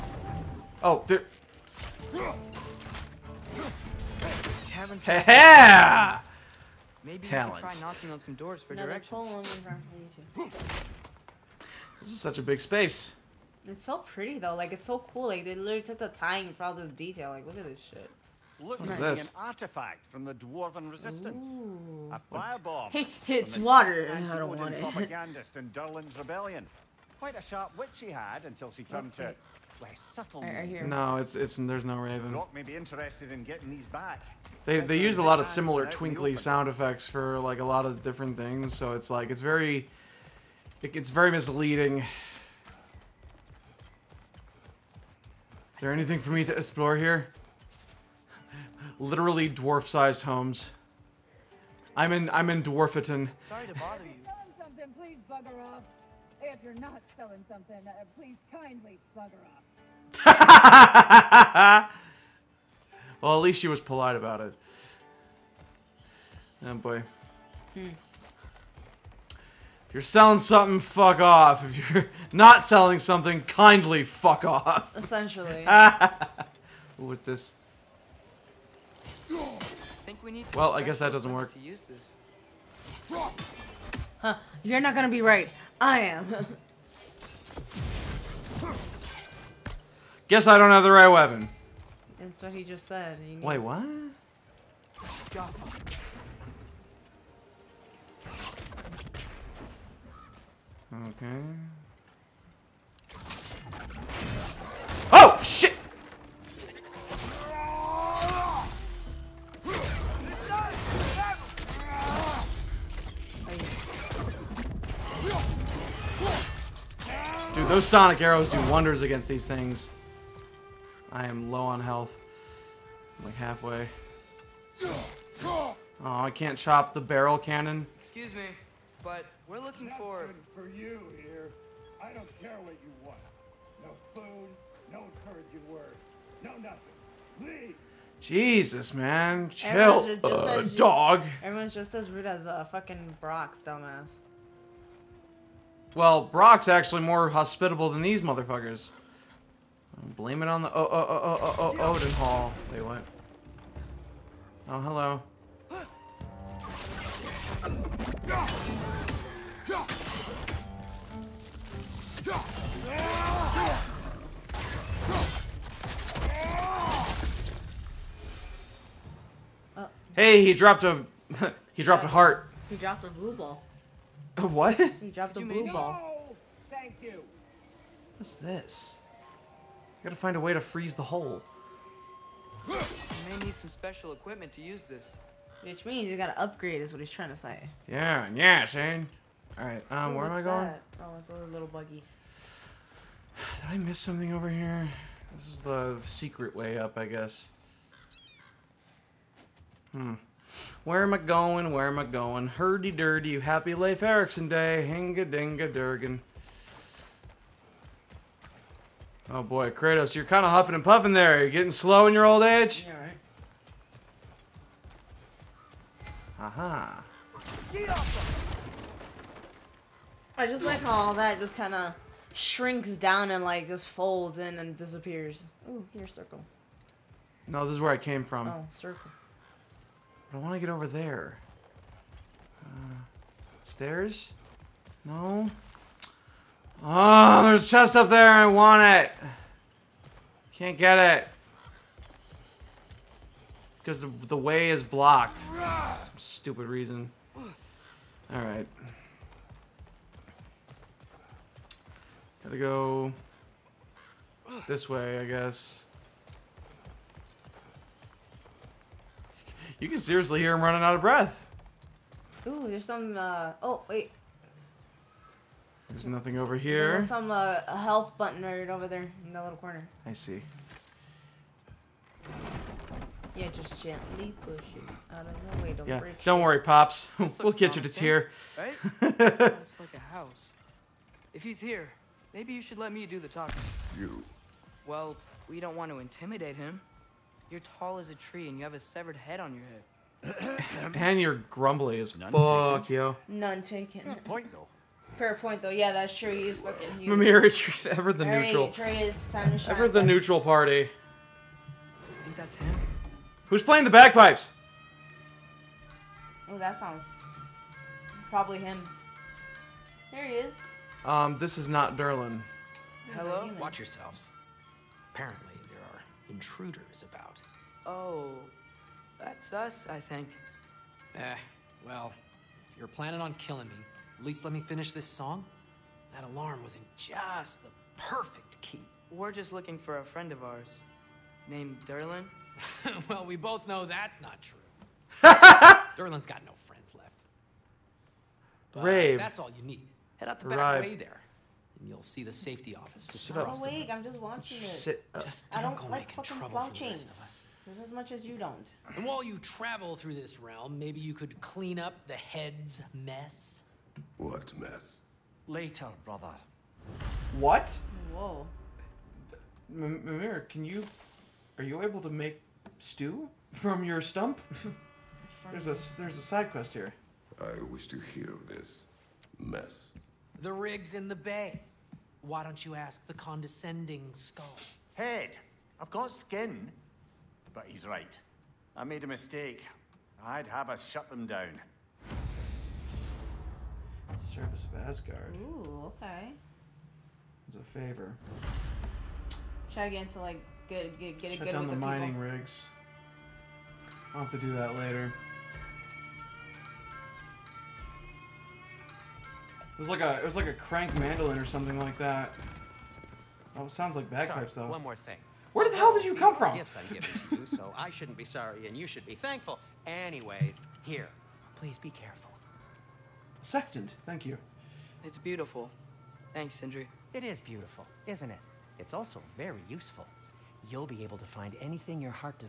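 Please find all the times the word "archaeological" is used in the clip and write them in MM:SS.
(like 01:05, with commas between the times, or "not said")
not said.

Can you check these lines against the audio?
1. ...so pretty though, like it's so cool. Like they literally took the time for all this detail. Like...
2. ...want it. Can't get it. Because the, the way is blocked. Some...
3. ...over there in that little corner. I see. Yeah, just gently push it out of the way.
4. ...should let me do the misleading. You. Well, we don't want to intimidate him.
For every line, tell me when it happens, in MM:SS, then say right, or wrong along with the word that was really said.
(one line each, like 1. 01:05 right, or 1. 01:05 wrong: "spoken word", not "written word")
1. 00:13 right
2. 03:58 right
3. 04:28 right
4. 04:42 wrong: "talking", not "misleading".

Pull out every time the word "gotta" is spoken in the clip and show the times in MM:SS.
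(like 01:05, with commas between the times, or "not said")
03:00, 03:06, 04:12.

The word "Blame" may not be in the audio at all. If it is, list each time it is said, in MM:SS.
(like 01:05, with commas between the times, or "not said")
02:30.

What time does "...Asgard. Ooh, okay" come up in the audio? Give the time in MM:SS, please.
06:24.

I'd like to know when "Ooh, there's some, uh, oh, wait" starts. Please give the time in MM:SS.
04:22.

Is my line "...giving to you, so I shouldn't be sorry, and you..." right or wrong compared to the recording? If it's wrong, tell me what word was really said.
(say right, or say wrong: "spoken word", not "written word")
right.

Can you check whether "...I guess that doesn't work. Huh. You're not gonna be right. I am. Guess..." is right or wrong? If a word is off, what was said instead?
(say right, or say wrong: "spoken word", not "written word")
right.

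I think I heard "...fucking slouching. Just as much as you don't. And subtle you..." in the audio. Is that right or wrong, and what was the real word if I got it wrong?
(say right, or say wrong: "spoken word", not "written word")
wrong: "while", not "subtle".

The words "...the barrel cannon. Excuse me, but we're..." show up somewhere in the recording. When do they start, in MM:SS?
02:06.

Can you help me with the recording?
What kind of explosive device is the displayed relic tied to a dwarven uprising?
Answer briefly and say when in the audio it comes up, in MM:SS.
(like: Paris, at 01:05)
Firebomb, at 00:22.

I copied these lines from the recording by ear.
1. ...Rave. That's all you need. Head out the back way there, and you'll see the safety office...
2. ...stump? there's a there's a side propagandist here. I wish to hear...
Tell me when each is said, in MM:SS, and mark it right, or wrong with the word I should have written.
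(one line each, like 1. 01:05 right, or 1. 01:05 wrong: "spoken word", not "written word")
1. 05:38 right
2. 06:04 wrong: "quest", not "propagandist".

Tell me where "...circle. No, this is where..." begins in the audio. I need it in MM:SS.
03:46.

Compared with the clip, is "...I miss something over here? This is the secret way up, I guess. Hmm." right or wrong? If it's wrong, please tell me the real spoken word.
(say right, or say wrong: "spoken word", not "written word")
right.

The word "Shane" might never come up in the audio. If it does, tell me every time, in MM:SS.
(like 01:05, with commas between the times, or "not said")
03:08.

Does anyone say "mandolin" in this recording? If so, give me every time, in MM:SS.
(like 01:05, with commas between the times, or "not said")
06:40.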